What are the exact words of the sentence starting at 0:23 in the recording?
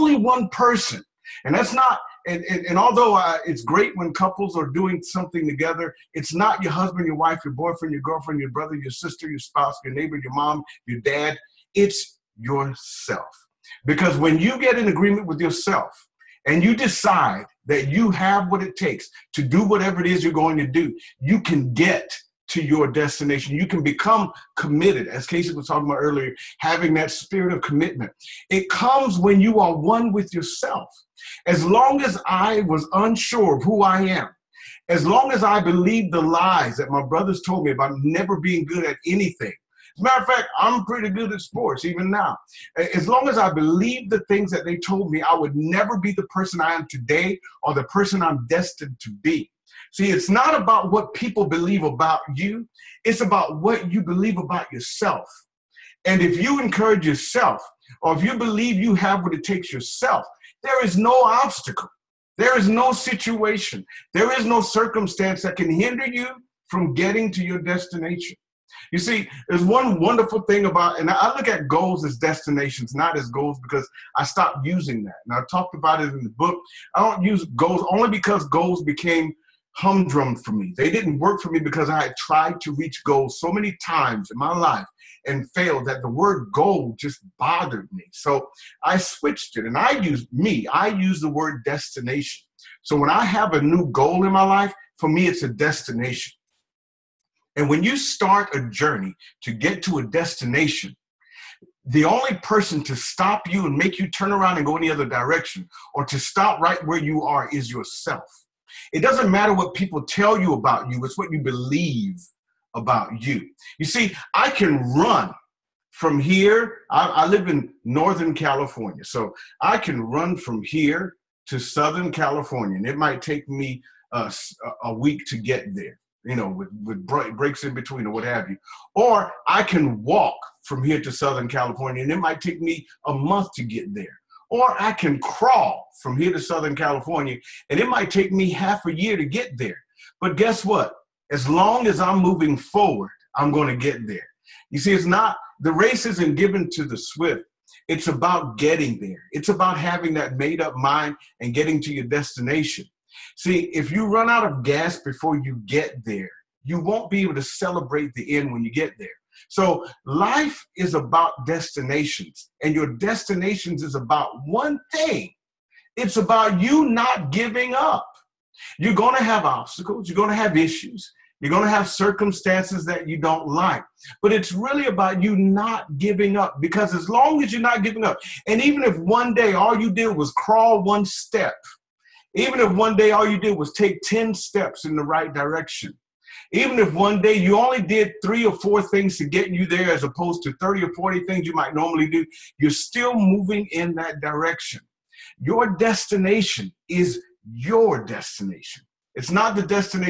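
You can become committed, as Casey was talking about earlier, having that spirit of commitment.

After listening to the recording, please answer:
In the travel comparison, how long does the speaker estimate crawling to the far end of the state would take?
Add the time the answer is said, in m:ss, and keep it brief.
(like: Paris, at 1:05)
Half a year, at 2:18.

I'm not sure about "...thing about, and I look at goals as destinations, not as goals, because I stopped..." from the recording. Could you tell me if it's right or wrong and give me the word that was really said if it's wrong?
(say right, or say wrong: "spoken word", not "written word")
right.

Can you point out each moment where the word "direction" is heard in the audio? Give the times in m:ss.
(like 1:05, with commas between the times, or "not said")
1:45, 3:05, 3:14.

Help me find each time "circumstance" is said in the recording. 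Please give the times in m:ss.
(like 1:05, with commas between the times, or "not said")
1:04, 2:51.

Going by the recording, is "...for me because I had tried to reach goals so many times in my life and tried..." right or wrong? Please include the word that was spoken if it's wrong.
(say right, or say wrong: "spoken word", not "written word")
wrong: "failed", not "tried".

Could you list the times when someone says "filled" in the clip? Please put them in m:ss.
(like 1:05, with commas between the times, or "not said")
not said.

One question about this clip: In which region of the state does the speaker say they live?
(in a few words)
Northern California.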